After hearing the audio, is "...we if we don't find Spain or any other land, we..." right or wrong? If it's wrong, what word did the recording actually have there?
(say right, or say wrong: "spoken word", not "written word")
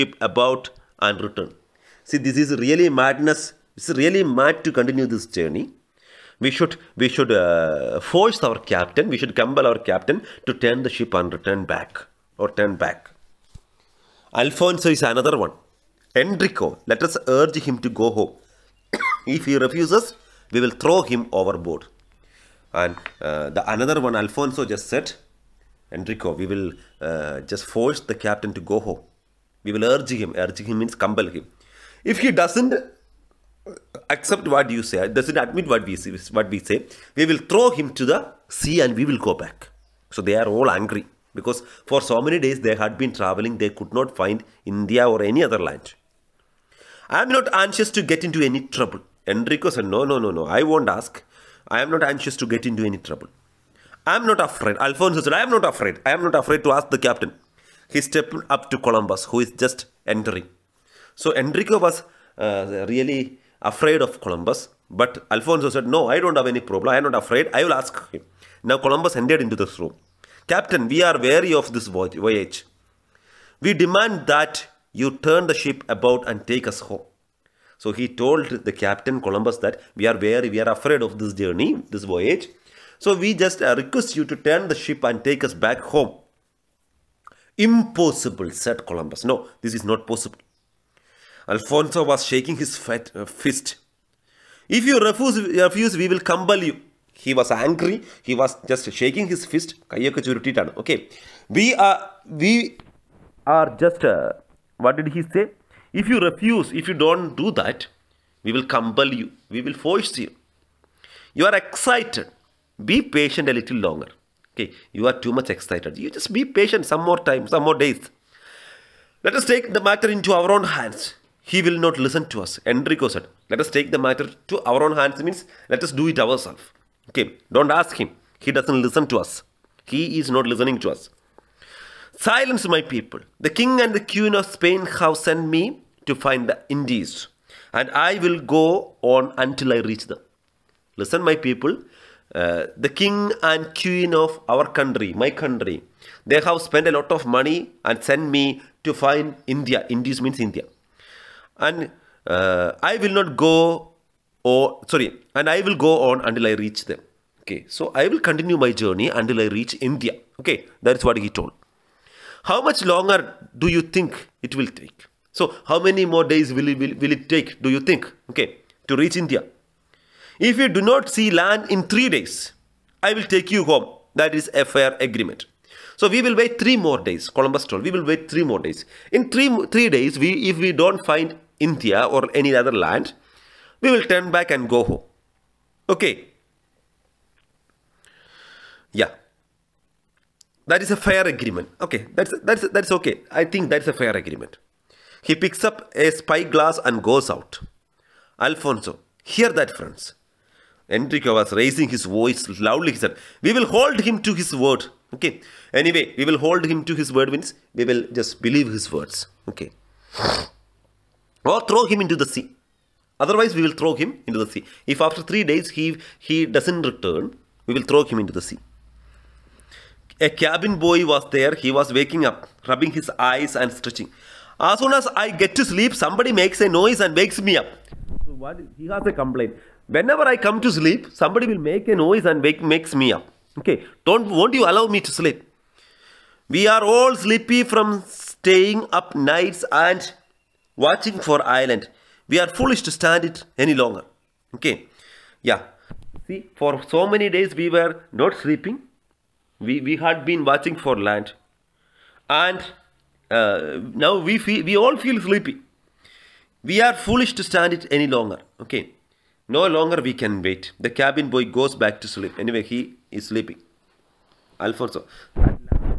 wrong: "India", not "Spain".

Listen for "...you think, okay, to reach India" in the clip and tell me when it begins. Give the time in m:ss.
2:47.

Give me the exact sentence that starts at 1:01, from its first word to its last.
So Enrico was uh, really afraid of Columbus, but Alfonso said, No, I don't have any problem.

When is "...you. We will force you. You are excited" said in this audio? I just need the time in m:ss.
1:49.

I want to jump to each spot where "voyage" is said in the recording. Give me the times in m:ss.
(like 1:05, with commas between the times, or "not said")
1:11, 1:22.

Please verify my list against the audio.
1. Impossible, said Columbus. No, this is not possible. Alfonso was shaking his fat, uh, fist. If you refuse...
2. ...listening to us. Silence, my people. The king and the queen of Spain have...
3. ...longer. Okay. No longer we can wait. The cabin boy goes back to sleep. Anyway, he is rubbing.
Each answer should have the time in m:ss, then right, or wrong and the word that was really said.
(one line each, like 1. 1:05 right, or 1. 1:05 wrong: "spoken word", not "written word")
1. 1:27 right
2. 2:10 right
3. 4:18 wrong: "sleeping", not "rubbing".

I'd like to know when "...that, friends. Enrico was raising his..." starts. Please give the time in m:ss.
3:19.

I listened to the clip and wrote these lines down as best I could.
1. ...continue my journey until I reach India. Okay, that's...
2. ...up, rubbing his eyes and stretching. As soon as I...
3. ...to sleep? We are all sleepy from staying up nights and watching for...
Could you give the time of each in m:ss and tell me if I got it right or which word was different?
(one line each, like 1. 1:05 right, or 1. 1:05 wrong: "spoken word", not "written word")
1. 2:38 right
2. 3:42 right
3. 3:54 right.